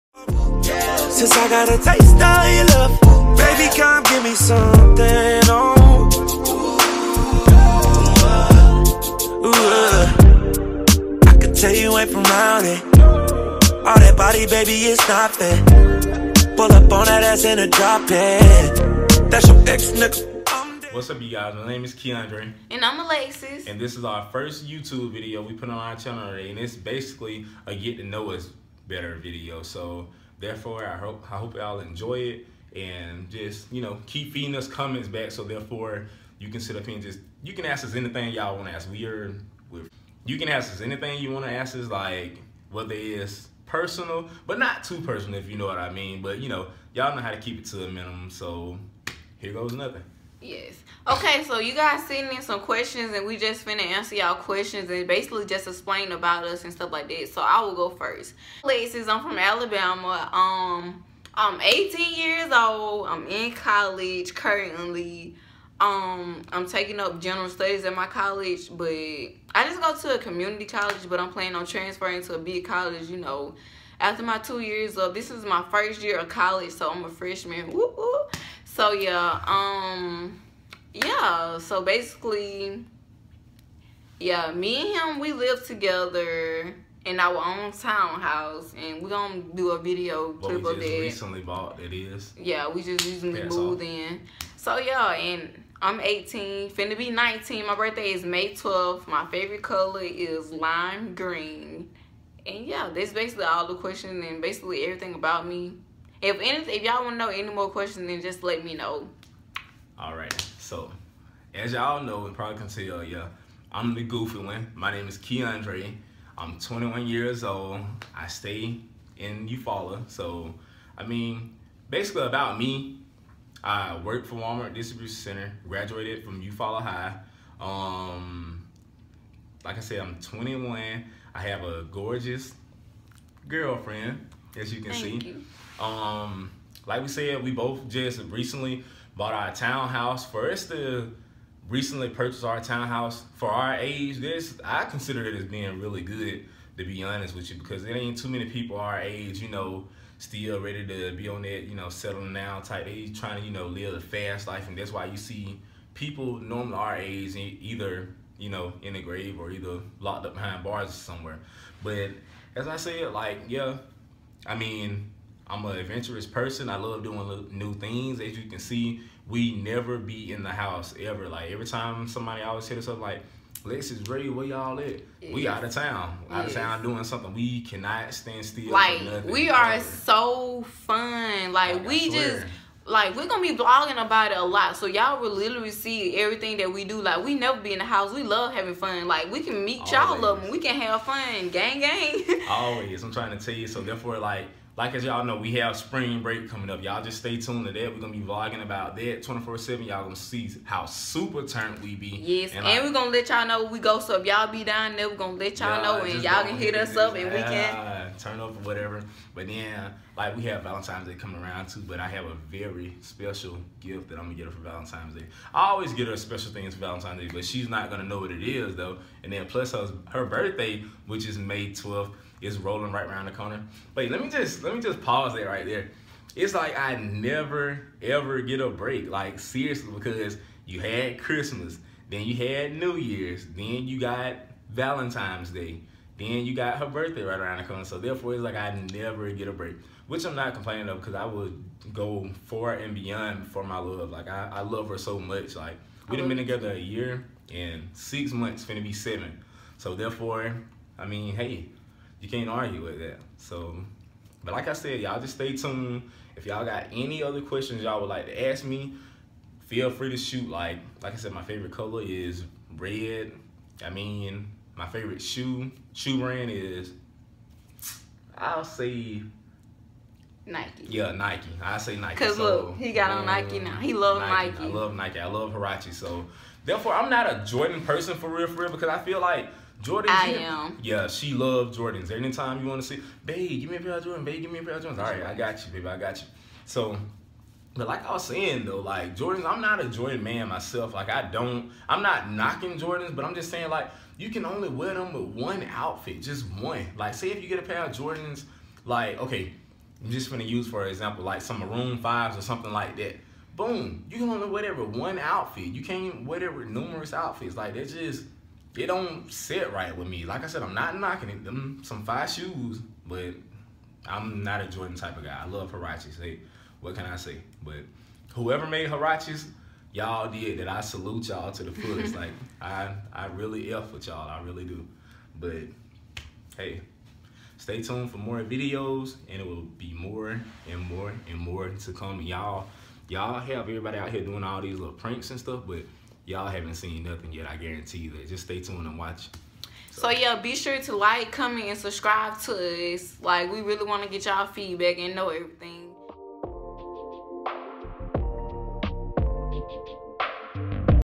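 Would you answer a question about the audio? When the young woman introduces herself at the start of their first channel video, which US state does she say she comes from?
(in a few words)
Alabama.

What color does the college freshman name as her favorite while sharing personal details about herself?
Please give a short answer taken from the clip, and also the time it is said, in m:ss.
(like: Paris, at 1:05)
Lime green, at 1:40.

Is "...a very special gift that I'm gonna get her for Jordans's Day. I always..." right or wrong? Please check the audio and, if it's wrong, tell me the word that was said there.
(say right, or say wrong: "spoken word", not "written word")
wrong: "Valentine", not "Jordans".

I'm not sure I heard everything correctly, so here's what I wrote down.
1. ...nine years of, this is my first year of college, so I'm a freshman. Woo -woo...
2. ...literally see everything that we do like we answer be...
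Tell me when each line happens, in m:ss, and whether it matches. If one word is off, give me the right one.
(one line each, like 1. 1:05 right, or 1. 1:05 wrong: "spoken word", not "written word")
1. 1:14 wrong: "two", not "nine"
2. 3:05 wrong: "never", not "answer".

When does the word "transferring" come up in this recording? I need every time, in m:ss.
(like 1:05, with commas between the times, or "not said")
1:11.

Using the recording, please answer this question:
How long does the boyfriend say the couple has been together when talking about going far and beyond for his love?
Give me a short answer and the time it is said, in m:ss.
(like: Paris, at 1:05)
A year and six months, at 4:06.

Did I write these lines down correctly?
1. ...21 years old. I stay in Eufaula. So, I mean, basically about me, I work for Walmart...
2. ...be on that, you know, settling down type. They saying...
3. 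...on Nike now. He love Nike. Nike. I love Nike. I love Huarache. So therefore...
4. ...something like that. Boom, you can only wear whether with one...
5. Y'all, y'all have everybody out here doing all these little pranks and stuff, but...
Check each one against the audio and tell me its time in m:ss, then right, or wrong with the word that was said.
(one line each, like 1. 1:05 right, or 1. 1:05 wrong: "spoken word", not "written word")
1. 1:56 right
2. 2:31 wrong: "trying", not "saying"
3. 4:33 right
4. 5:02 wrong: "whatever", not "whether"
5. 5:32 right.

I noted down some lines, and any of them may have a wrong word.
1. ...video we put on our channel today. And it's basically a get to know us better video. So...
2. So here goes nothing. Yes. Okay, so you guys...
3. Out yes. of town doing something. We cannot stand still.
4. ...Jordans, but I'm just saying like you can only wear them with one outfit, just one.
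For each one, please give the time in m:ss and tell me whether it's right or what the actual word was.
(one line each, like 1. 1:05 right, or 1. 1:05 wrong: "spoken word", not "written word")
1. 0:25 right
2. 0:48 right
3. 2:56 right
4. 4:52 right.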